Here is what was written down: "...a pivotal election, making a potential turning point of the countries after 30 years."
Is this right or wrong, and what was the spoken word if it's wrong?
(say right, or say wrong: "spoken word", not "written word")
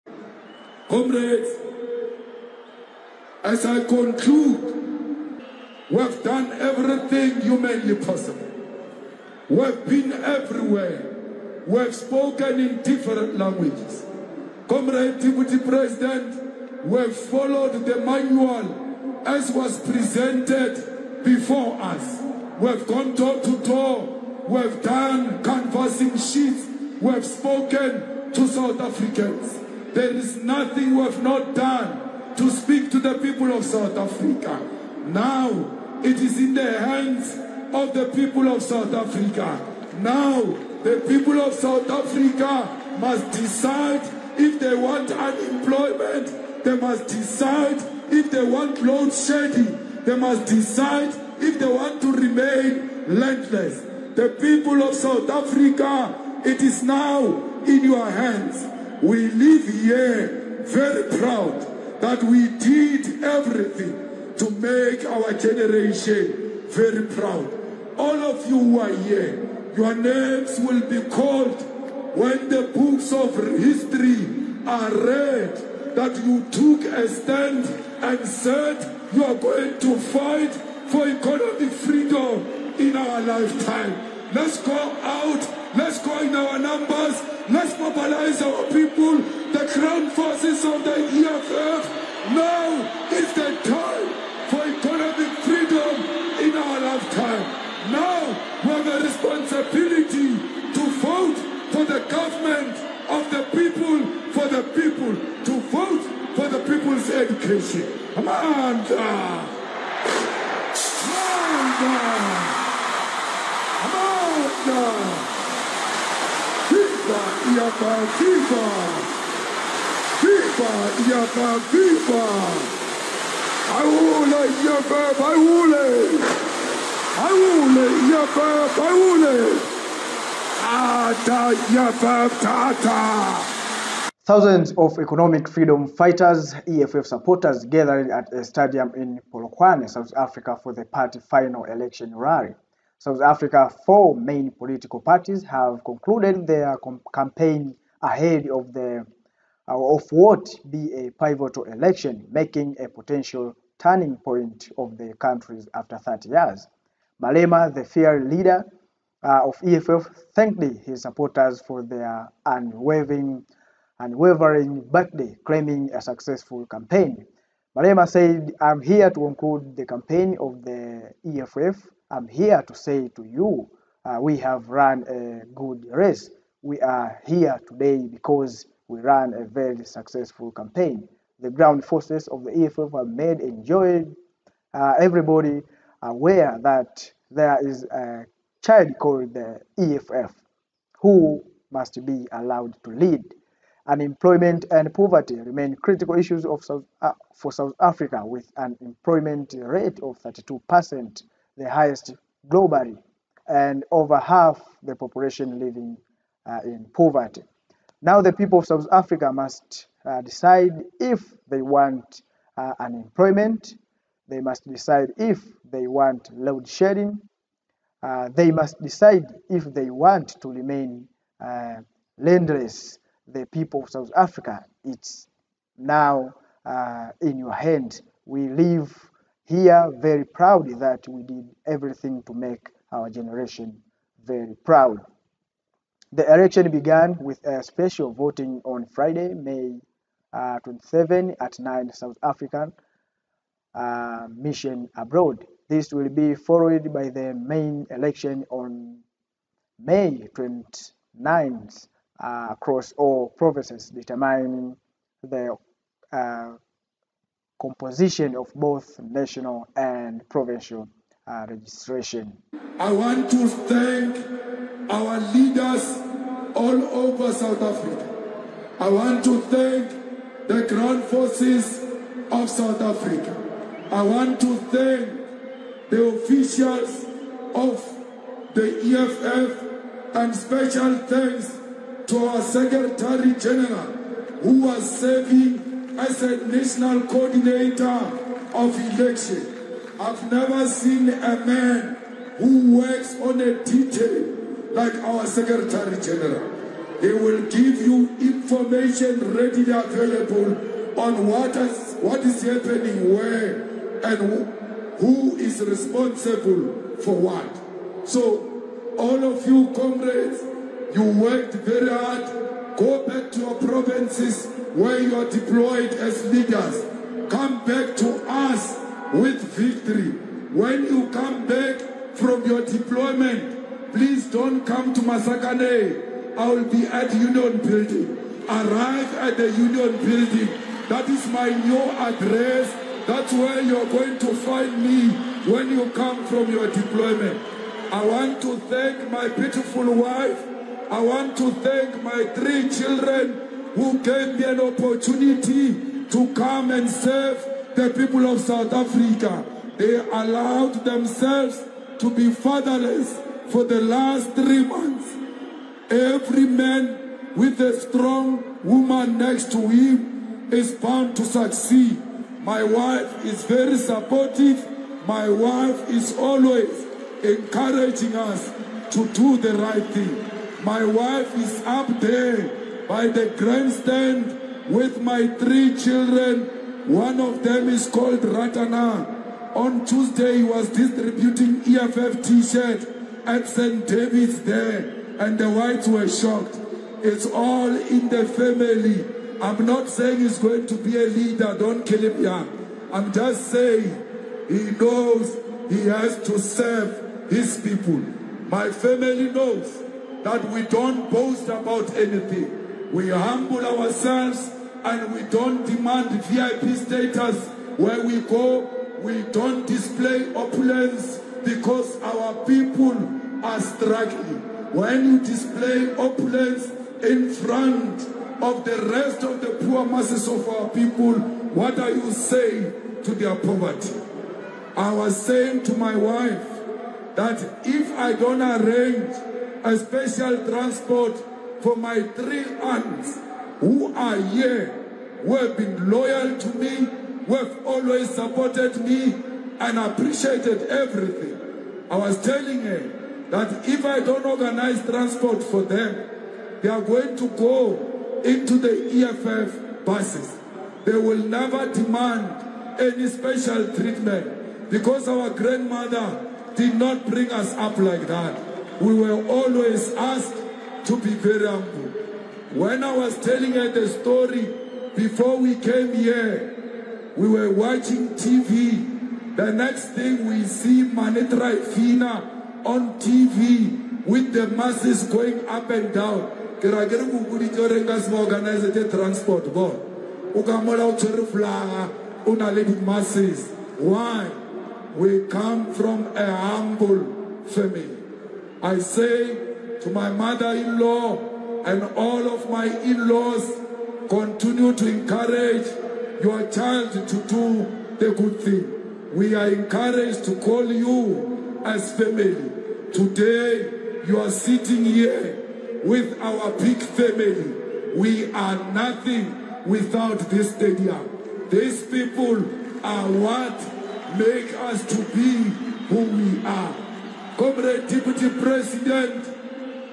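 right.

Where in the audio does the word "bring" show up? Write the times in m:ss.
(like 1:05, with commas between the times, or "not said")
7:37.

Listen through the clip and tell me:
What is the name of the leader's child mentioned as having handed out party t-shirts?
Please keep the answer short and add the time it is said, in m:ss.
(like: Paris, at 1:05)
Ratana, at 6:18.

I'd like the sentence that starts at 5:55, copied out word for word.
Every man with a strong woman next to him is bound to succeed.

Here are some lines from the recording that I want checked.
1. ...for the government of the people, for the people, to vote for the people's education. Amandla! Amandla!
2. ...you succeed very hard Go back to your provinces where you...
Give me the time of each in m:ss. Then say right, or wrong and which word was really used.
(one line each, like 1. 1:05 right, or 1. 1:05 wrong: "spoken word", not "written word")
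1. 1:41 right
2. 5:10 wrong: "worked", not "succeed".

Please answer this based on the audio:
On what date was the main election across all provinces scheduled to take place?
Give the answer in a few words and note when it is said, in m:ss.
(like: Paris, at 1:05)
May 29, at 4:09.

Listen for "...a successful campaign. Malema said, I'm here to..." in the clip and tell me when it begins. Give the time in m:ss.
2:45.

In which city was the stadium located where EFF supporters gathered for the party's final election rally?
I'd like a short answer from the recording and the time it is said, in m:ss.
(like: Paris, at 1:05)
Polokwane, at 2:19.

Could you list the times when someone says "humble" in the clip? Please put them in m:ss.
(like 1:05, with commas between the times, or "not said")
6:43, 7:41, 8:06.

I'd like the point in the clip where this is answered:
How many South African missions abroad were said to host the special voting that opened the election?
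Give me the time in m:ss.
4:01.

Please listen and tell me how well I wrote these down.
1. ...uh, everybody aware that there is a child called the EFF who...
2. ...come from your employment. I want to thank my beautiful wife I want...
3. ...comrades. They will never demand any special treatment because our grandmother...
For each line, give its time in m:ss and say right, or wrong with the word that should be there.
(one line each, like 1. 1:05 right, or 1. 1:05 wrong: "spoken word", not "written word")
1. 3:04 right
2. 5:35 wrong: "deployment", not "employment"
3. 7:29 wrong: "buses", not "comrades".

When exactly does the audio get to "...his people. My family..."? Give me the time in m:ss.
6:37.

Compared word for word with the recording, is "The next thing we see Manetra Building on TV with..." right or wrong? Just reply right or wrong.
wrong.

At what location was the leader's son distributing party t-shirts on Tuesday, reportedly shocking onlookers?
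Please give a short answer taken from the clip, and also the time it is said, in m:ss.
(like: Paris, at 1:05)
St. David's, at 6:23.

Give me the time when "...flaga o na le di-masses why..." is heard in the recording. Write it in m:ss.
8:01.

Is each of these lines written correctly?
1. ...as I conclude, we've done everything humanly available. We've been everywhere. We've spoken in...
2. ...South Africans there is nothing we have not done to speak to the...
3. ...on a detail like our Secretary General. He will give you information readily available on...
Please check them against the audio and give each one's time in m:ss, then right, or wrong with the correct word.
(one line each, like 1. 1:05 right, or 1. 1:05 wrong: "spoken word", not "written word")
1. 0:03 wrong: "possible", not "available"
2. 0:28 right
3. 4:53 right.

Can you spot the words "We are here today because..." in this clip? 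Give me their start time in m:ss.
2:56.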